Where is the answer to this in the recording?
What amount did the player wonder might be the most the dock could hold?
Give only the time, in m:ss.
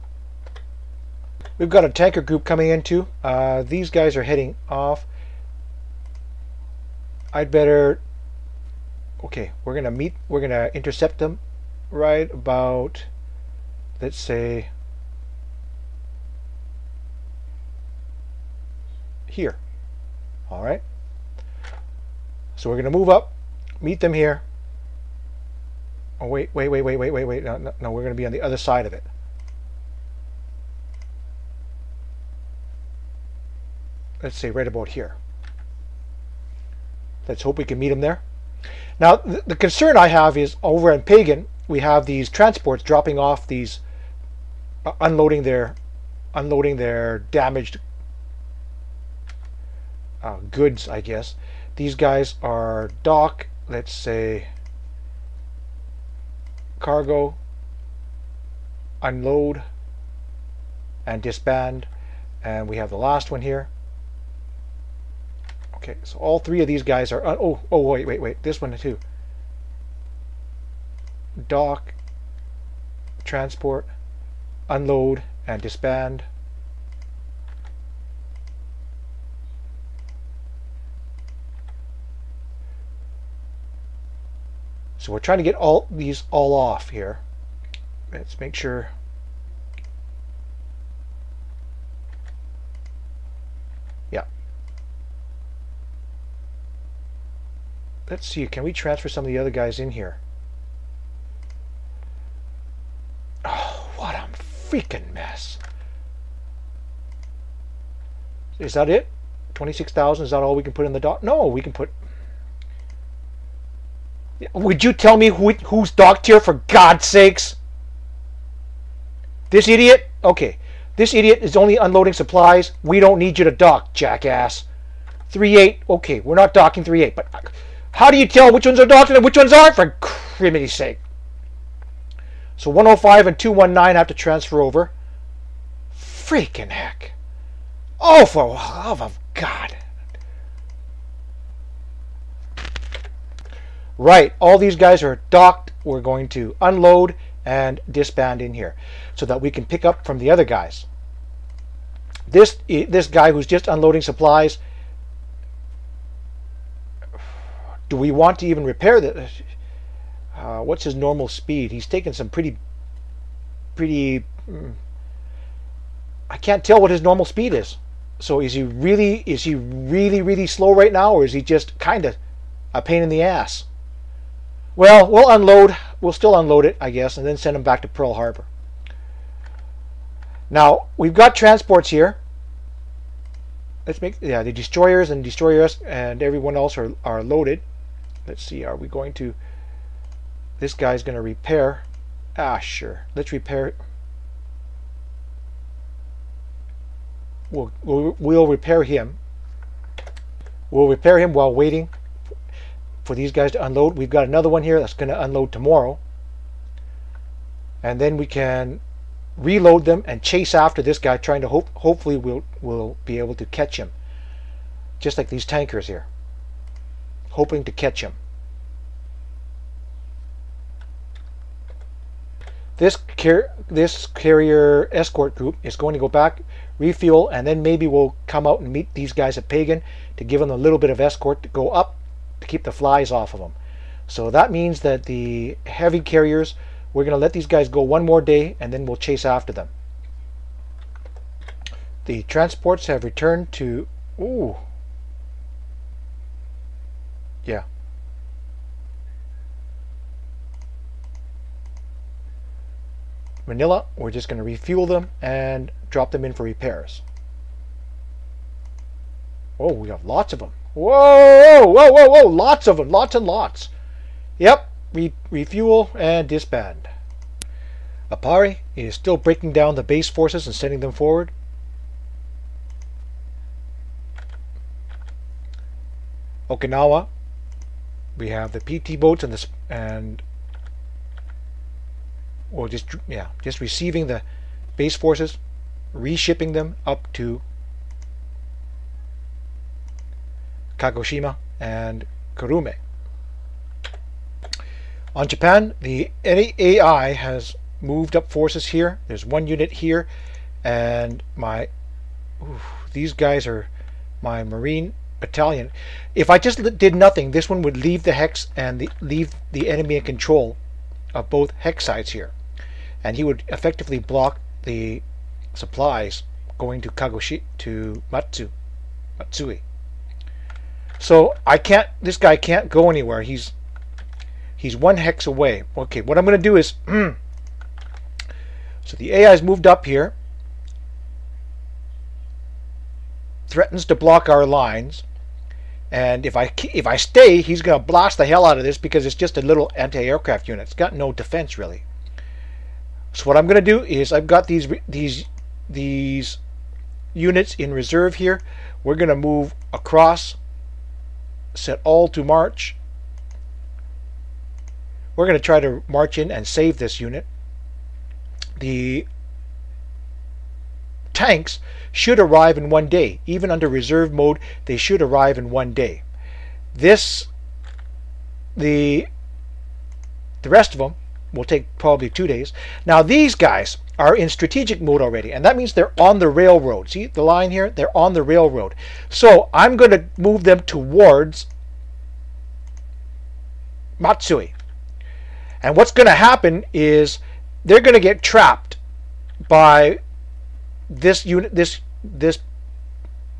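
1:49.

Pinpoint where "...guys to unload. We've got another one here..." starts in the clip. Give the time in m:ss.
3:23.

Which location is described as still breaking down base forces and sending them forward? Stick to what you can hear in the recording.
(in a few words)
Aparri.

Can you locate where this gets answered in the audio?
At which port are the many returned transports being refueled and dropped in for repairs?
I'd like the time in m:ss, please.
4:13.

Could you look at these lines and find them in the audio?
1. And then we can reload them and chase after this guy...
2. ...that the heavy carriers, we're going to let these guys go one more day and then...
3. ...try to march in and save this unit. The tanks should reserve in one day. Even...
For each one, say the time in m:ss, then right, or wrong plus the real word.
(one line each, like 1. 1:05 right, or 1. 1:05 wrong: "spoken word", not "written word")
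1. 3:27 right
2. 3:54 right
3. 5:55 wrong: "arrive", not "reserve".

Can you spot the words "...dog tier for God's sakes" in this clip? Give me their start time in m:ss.
1:55.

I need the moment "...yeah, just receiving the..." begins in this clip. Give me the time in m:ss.
4:43.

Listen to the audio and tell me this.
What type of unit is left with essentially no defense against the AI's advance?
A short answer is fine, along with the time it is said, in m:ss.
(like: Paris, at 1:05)
Anti-aircraft unit, at 5:39.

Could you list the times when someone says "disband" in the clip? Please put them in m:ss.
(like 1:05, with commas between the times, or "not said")
1:01, 1:15, 2:27, 4:26.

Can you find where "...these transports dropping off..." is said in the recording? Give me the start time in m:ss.
0:42.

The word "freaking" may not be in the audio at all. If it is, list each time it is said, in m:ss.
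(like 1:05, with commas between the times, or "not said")
1:44, 2:15.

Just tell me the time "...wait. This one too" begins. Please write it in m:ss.
1:08.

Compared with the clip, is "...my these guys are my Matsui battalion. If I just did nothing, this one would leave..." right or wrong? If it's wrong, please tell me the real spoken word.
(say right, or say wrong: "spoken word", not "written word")
wrong: "Marine", not "Matsui".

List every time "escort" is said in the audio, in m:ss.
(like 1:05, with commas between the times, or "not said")
3:44, 3:50.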